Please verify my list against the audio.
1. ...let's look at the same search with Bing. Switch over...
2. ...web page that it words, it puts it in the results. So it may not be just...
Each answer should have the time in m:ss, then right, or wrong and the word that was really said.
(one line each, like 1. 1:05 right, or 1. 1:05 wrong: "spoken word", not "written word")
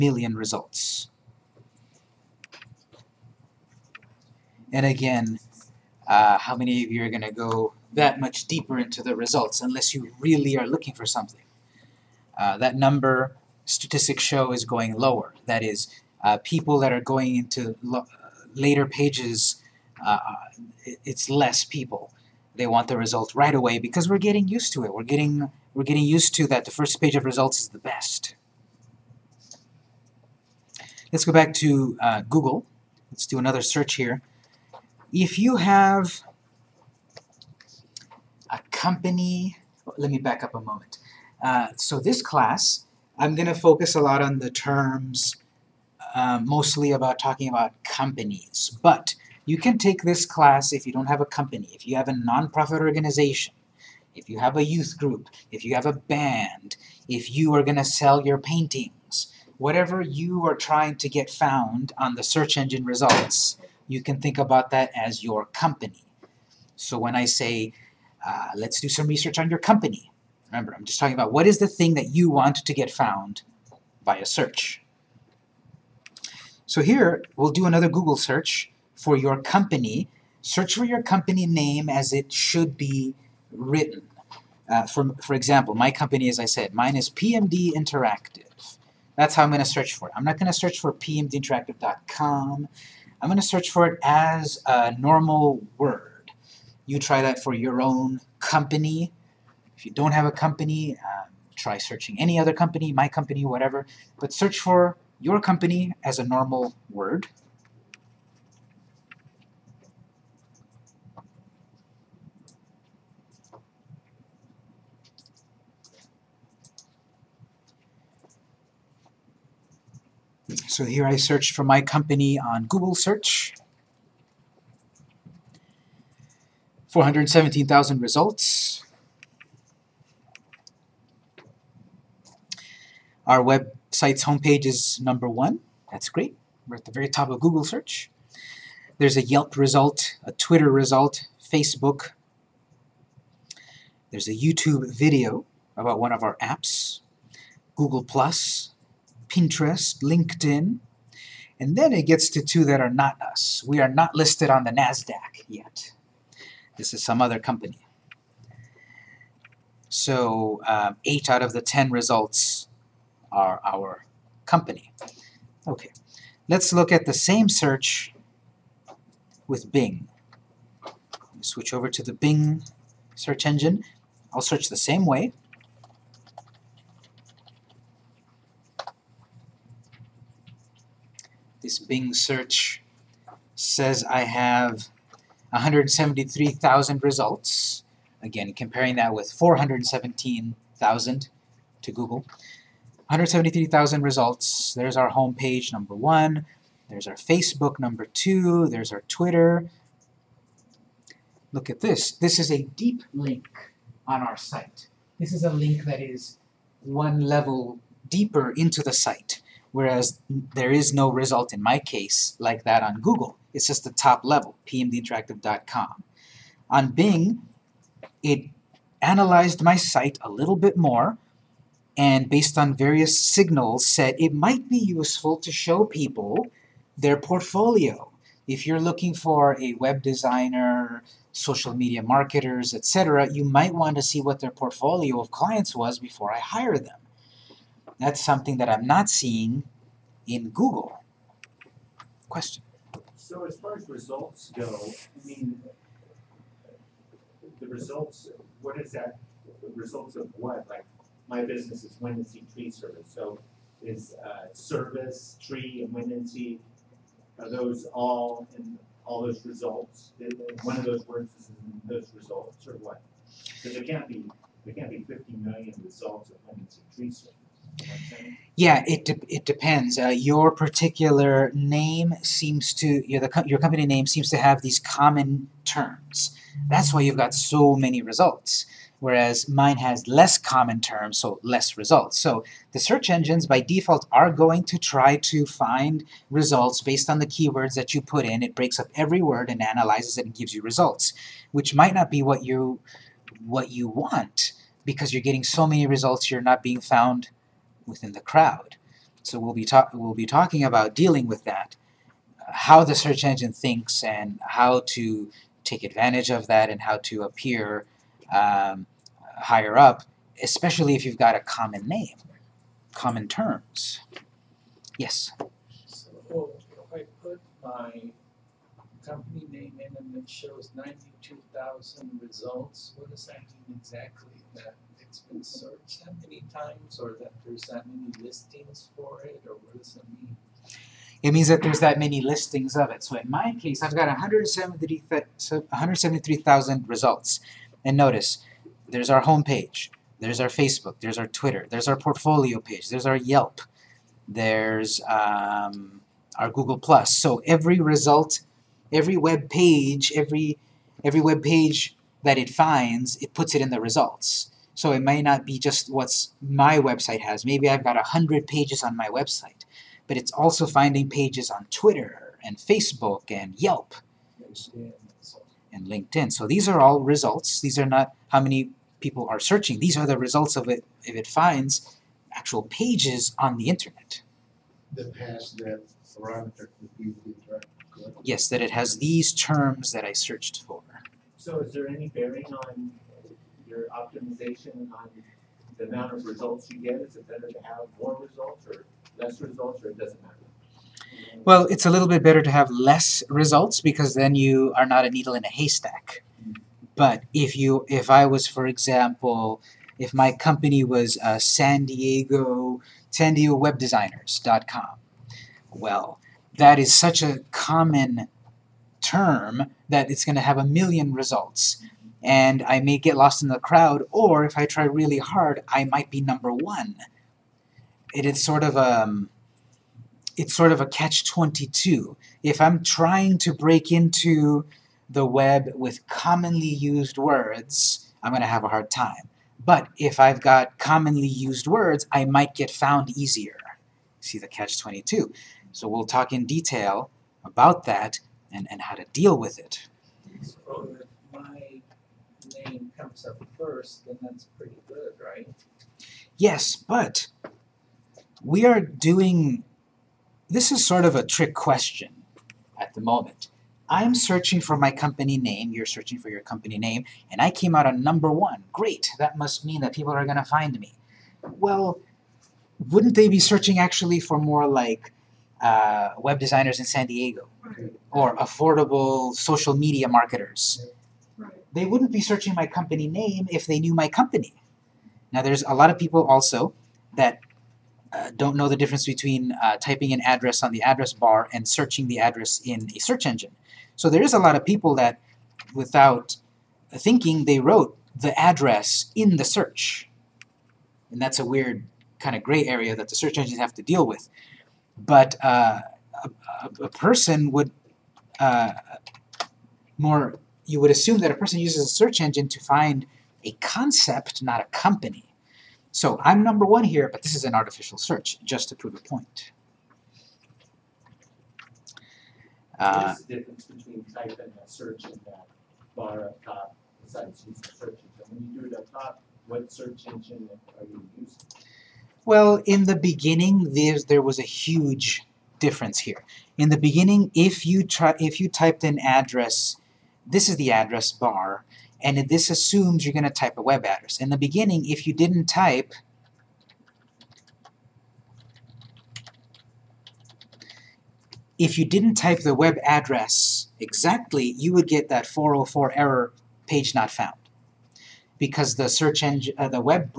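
1. 2:46 right
2. 5:51 wrong: "finds", not "words".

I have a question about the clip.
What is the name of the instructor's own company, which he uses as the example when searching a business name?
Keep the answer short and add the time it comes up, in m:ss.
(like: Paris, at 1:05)
PMD Interactive, at 1:27.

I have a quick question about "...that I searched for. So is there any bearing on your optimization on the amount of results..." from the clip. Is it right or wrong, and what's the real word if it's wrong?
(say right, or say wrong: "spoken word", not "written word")
right.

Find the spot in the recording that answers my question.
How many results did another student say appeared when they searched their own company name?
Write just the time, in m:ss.
5:20.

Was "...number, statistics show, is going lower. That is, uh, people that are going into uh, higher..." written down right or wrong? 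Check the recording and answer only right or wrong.
wrong.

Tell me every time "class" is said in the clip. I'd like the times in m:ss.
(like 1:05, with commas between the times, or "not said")
0:42, 0:50.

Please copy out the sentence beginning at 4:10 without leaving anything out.
Like, my business is wind tree service, so is uh, service, tree, and wind are those all in all those results?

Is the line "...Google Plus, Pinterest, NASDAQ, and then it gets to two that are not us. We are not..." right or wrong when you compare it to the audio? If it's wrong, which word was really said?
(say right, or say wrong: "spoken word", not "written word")
wrong: "LinkedIn", not "NASDAQ".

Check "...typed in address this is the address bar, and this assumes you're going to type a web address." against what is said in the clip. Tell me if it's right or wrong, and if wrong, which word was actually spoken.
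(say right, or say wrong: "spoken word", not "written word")
right.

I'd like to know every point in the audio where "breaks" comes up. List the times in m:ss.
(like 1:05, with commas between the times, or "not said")
4:48, 7:03.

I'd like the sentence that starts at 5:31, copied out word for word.
It means that there's that many listings of it.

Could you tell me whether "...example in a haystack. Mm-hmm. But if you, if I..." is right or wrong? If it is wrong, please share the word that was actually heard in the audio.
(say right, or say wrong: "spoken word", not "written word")
wrong: "needle", not "example".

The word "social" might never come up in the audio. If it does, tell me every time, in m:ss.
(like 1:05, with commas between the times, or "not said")
3:51, 7:49.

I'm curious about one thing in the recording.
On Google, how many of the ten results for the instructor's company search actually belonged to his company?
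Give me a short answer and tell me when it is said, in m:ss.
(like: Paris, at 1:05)
8, at 2:41.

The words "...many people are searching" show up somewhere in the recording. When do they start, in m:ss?
6:08.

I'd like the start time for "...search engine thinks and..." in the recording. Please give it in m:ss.
5:02.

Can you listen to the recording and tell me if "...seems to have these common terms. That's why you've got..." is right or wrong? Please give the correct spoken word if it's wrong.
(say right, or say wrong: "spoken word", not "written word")
right.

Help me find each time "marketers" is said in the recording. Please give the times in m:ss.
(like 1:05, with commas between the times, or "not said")
3:52, 7:50.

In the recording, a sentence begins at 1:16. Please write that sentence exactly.
So here, we'll do another Google search for your company.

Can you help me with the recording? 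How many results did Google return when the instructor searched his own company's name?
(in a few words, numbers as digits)
417,000.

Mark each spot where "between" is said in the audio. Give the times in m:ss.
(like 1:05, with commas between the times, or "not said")
7:59, 8:33.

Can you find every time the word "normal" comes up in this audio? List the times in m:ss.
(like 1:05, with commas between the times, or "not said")
1:34, 1:46.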